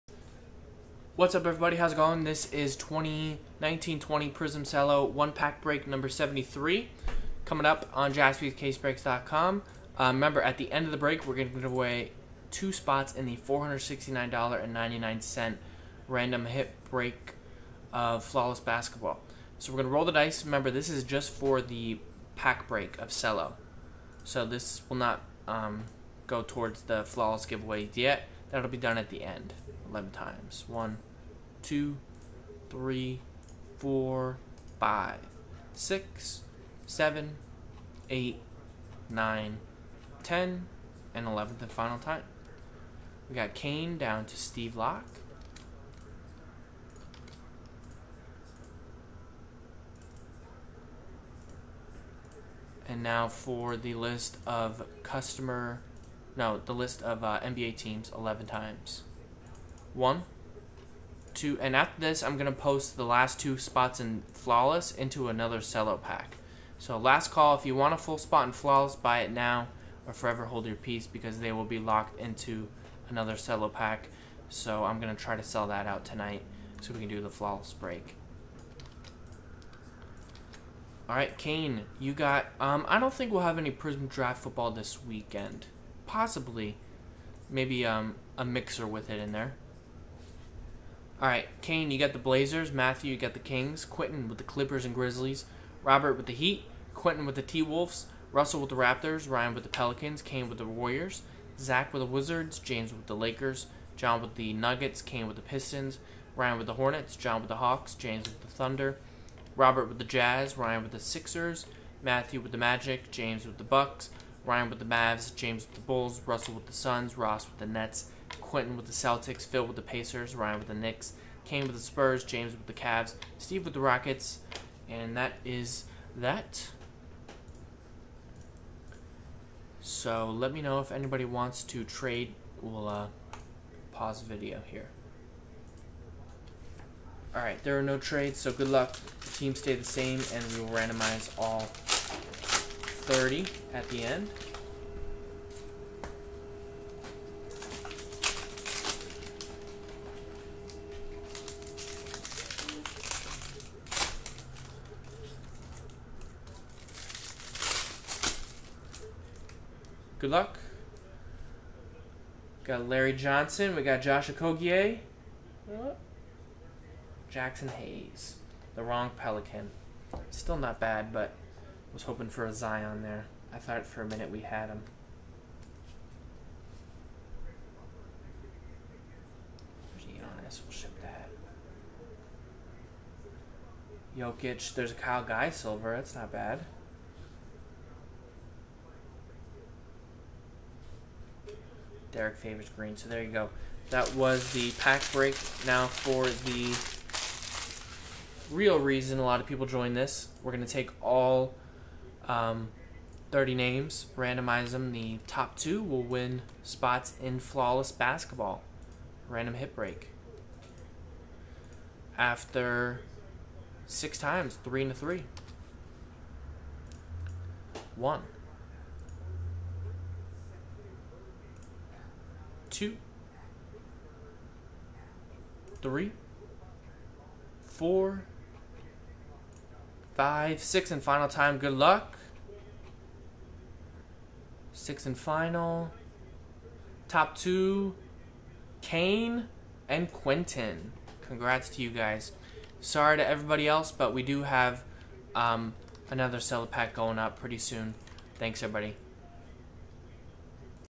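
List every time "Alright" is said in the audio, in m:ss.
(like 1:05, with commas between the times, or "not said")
1:21, 2:17.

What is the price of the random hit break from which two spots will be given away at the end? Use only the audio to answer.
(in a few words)
$469.99.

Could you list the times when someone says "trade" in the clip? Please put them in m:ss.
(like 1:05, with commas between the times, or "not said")
2:11, 2:17.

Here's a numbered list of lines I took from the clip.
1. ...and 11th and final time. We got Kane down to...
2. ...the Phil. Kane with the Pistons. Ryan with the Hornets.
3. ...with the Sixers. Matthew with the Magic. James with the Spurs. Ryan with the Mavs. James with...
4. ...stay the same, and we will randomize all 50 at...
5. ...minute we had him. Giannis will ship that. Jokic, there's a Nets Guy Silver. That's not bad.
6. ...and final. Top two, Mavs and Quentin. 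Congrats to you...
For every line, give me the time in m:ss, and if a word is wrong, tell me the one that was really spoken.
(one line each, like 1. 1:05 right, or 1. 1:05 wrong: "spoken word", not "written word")
1. 0:41 right
2. 1:44 wrong: "Nuggets", not "Phil"
3. 1:50 wrong: "Bucks", not "Spurs"
4. 2:19 wrong: "30", not "50"
5. 2:54 wrong: "Kyle", not "Nets"
6. 3:55 wrong: "Kane", not "Mavs".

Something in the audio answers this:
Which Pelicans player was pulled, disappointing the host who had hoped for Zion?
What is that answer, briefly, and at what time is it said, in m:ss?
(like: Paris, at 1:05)
Jaxson Hayes, at 2:47.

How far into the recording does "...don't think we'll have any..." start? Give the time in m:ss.
1:22.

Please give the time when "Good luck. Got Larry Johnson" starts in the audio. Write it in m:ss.
2:40.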